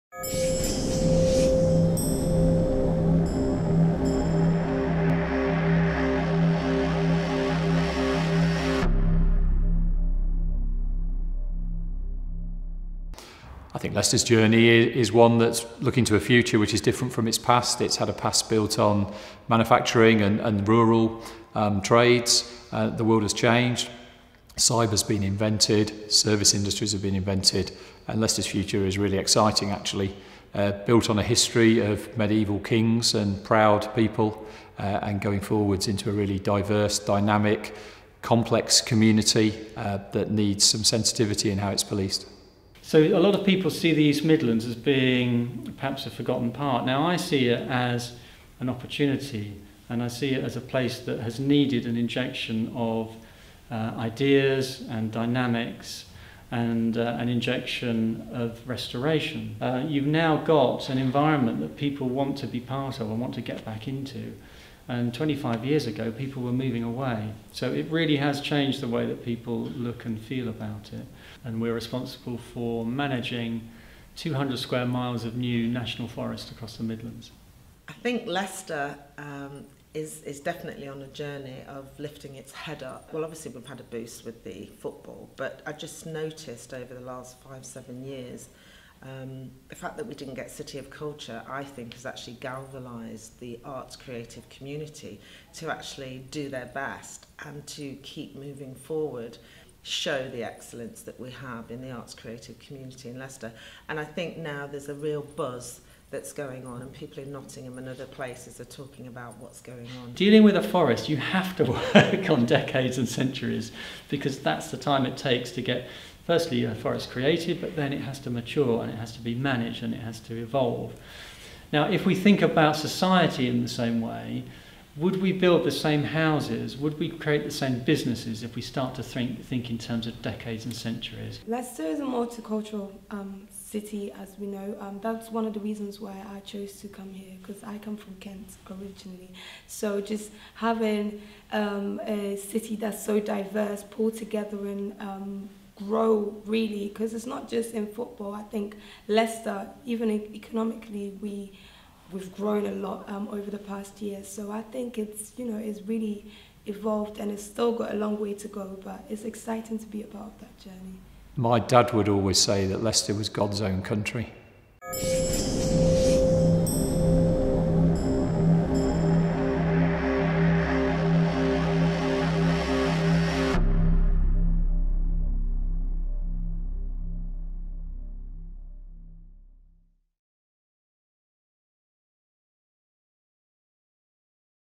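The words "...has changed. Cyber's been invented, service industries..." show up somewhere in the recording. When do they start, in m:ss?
0:23.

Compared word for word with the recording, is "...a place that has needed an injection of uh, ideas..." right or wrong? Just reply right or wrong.
right.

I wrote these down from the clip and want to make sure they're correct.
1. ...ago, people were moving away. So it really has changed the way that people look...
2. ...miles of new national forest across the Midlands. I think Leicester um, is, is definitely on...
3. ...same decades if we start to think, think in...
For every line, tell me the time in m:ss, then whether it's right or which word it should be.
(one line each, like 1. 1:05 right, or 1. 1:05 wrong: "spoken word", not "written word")
1. 1:05 right
2. 1:14 right
3. 2:07 wrong: "businesses", not "decades".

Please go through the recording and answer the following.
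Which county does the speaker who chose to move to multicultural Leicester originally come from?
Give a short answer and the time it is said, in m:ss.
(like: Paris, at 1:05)
Kent, at 2:18.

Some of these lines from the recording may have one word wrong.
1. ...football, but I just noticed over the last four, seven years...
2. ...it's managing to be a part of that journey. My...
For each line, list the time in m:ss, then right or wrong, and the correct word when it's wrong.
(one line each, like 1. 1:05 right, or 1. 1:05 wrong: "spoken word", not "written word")
1. 1:24 wrong: "five", not "four"
2. 2:39 wrong: "exciting", not "managing".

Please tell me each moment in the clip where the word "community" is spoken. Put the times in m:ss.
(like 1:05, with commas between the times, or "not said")
0:38, 1:34, 1:42.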